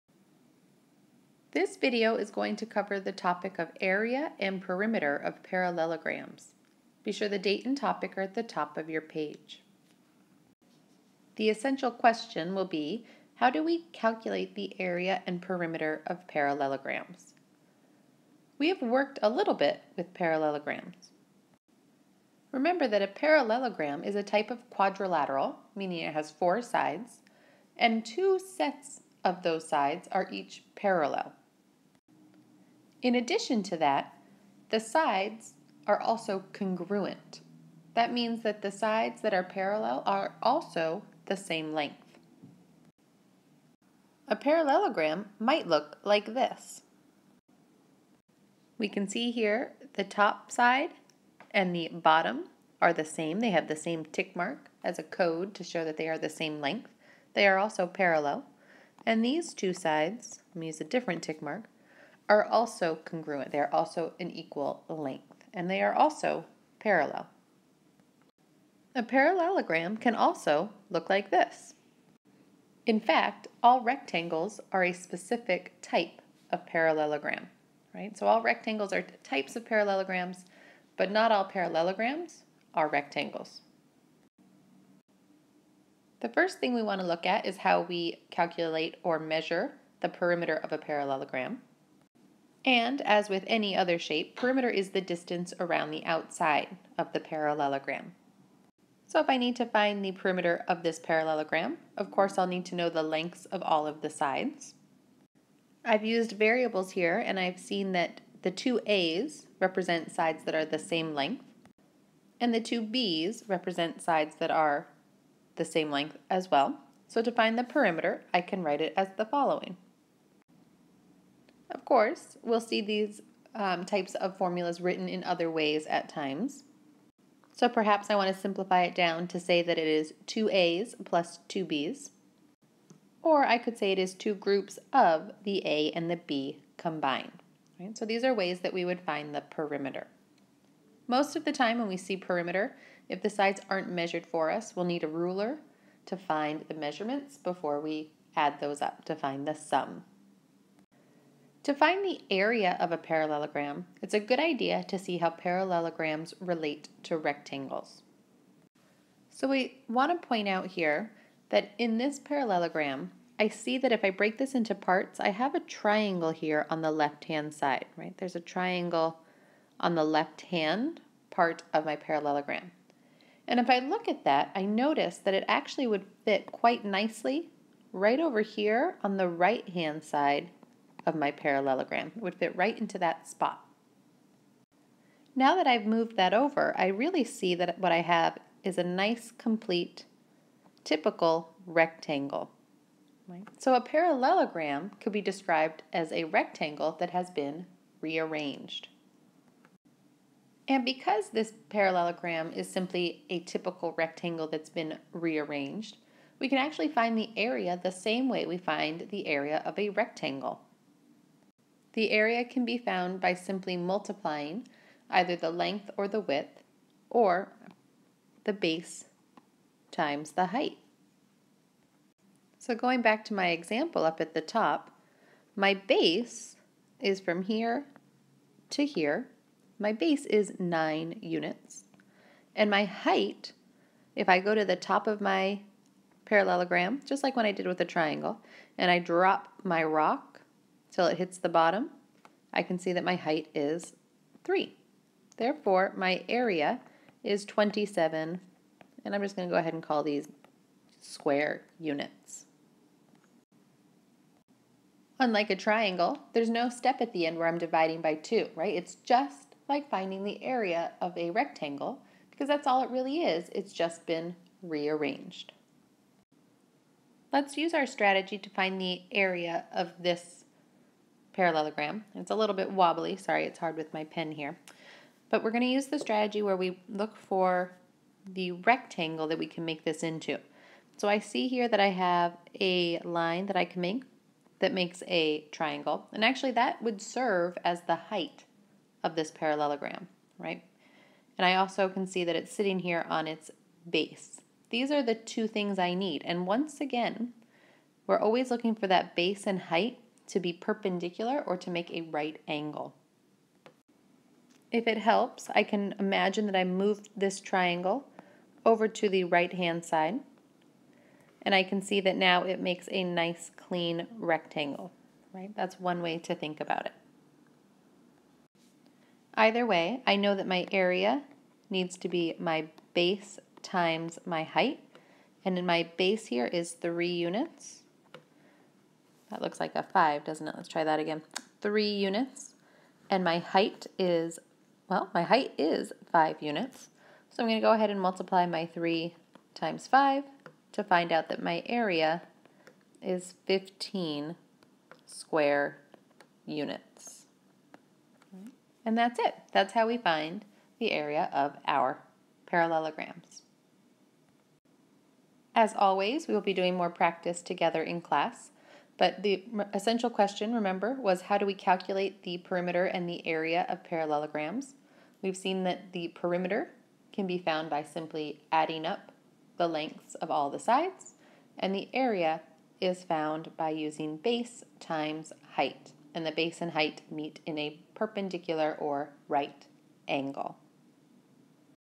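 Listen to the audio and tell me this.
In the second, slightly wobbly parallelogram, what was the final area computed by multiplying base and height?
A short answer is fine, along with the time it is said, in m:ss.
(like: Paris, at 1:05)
15 square units, at 5:43.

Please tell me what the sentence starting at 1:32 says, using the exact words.
And, as with any other shape, perimeter is the distance around the outside of the parallelogram.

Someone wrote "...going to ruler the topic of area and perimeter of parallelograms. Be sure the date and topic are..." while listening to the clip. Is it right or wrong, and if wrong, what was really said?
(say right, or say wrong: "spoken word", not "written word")
wrong: "cover", not "ruler".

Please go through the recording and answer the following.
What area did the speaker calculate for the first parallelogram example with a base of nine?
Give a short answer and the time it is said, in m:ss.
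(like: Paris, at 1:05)
27, at 4:07.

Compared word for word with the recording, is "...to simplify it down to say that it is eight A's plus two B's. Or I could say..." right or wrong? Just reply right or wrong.
wrong.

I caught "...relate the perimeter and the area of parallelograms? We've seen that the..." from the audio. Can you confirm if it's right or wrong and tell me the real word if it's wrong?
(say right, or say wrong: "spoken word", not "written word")
wrong: "calculate", not "relate".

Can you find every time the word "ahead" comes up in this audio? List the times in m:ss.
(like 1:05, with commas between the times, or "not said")
4:09, 5:37.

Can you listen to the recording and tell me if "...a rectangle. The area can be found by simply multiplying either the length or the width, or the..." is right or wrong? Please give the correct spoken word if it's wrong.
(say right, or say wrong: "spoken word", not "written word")
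right.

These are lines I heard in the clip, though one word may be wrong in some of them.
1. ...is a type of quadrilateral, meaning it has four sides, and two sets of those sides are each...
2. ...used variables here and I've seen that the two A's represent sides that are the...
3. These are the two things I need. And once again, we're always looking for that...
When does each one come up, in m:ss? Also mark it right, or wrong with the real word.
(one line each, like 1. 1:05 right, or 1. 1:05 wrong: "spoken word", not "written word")
1. 0:24 right
2. 1:46 right
3. 4:54 right.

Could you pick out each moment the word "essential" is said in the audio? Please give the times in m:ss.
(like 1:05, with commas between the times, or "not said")
0:11, 5:59.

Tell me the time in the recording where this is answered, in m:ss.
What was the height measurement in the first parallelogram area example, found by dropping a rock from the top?
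4:03.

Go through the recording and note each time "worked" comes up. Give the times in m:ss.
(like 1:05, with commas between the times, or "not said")
0:18.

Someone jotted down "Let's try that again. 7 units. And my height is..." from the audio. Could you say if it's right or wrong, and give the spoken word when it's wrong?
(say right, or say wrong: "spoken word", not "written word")
wrong: "3", not "7".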